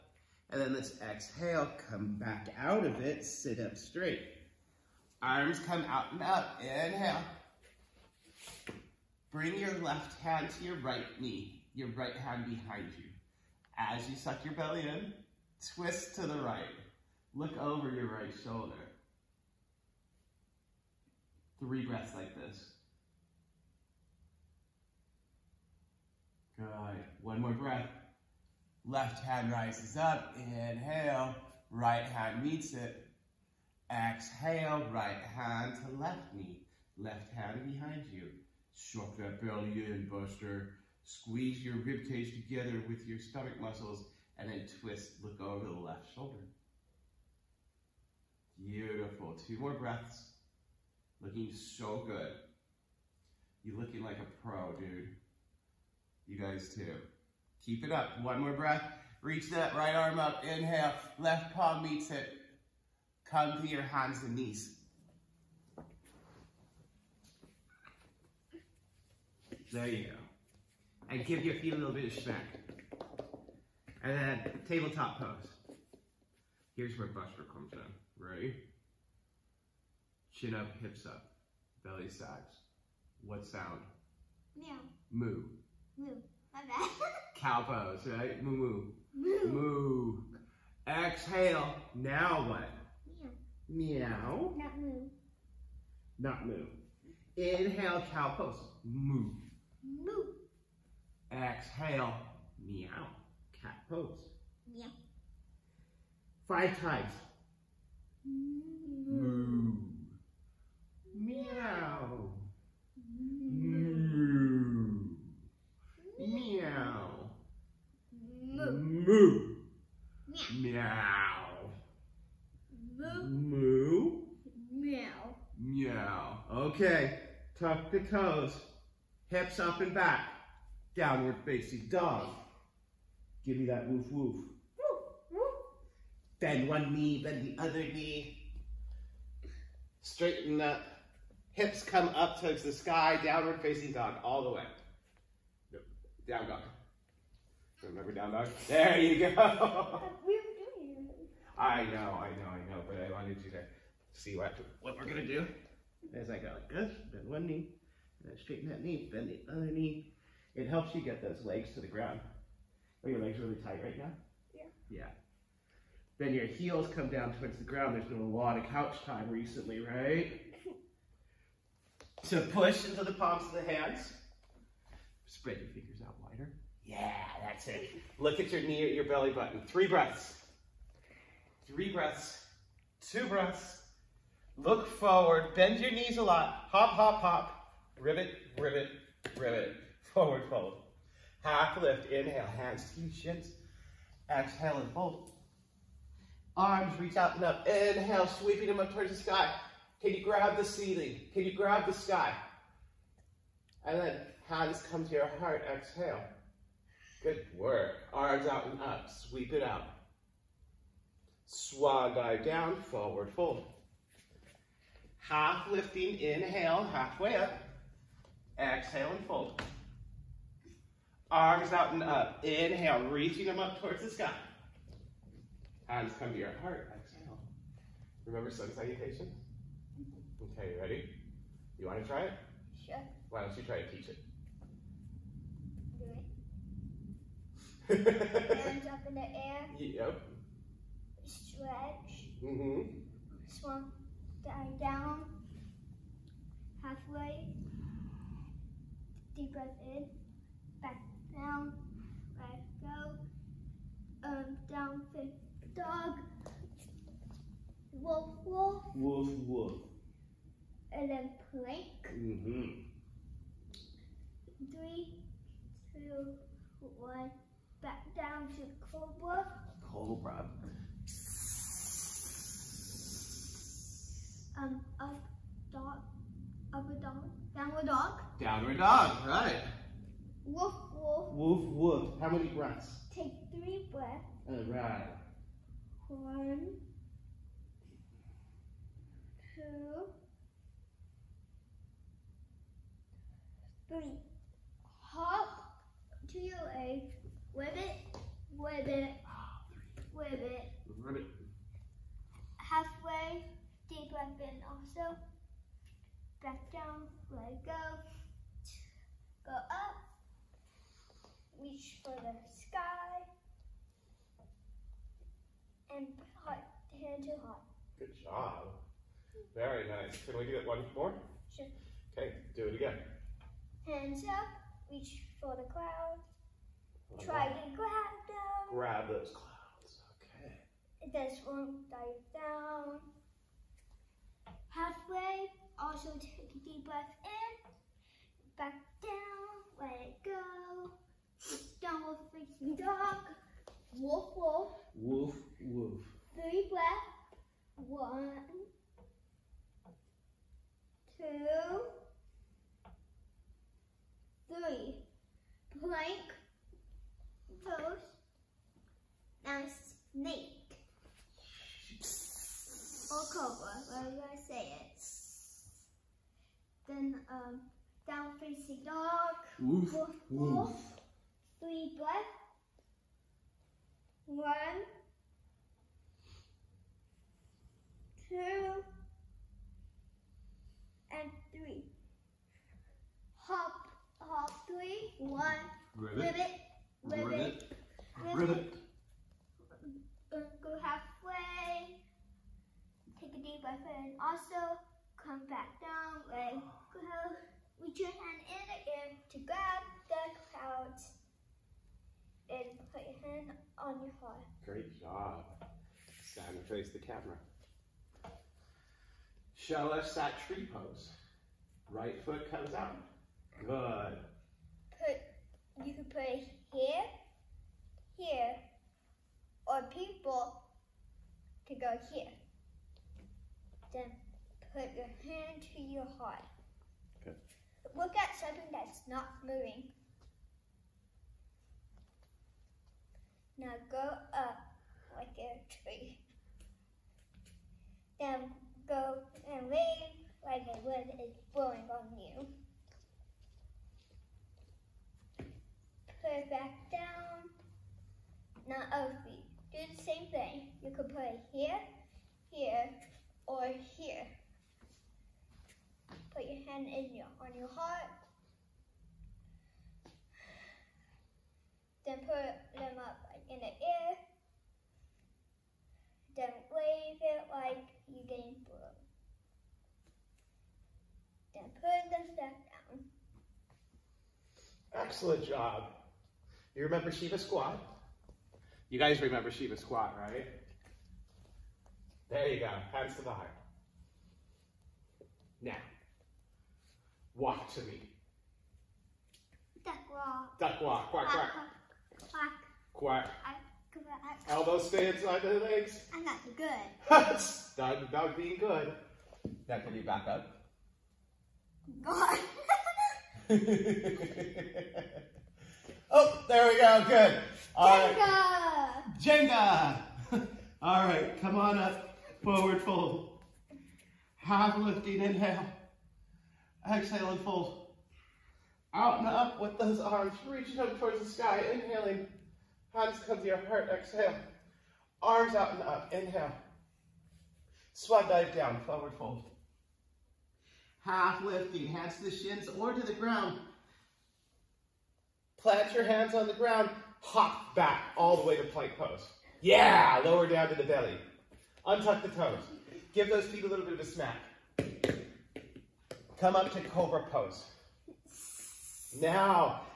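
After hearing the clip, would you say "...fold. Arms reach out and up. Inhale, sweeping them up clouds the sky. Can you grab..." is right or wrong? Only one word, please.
wrong.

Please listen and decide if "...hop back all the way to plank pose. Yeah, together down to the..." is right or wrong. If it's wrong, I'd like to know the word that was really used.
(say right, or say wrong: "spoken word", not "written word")
wrong: "lower", not "together".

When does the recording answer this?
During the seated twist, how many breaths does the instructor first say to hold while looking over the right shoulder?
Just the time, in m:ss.
0:21.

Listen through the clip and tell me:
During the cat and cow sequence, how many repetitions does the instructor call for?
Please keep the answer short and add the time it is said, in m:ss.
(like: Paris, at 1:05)
5, at 1:46.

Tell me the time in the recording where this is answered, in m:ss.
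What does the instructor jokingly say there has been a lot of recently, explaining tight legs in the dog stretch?
2:48.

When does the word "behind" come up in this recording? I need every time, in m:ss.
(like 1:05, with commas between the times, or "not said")
0:12, 0:37.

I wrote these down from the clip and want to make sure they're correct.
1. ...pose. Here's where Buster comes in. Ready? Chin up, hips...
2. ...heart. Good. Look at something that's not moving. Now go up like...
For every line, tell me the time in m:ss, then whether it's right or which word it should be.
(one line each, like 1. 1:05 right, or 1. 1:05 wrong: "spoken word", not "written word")
1. 1:15 right
2. 7:06 right.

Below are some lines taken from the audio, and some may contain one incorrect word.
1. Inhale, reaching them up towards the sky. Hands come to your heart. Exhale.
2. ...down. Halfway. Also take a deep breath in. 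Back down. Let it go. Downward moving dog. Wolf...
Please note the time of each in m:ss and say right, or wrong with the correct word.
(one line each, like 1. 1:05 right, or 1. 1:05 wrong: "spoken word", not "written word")
1. 3:42 right
2. 5:32 wrong: "facing", not "moving".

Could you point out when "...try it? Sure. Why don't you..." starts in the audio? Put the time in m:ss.
3:52.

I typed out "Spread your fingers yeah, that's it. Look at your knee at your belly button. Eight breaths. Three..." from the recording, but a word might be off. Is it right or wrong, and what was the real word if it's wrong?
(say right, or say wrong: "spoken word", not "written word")
wrong: "Three", not "Eight".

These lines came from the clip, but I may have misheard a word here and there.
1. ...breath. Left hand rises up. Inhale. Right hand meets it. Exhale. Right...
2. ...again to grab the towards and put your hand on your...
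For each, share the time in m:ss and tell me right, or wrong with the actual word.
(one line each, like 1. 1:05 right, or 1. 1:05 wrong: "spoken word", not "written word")
1. 0:27 right
2. 6:38 wrong: "clouds", not "towards".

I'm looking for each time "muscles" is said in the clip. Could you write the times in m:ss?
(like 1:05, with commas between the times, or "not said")
0:43.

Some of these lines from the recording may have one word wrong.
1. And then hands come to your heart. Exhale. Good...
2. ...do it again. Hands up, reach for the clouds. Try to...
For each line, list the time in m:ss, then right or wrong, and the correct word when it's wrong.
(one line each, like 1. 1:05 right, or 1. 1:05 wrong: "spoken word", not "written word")
1. 3:23 right
2. 5:22 right.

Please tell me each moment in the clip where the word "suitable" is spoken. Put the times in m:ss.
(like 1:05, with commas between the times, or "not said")
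not said.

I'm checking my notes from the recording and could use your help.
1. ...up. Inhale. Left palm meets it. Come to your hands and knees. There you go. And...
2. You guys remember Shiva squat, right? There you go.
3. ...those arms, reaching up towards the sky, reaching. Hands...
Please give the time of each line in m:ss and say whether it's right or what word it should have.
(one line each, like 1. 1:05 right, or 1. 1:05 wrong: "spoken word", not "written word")
1. 1:00 right
2. 7:58 right
3. 8:39 wrong: "inhaling", not "reaching".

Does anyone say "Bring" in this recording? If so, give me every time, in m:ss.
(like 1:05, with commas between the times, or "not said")
0:09.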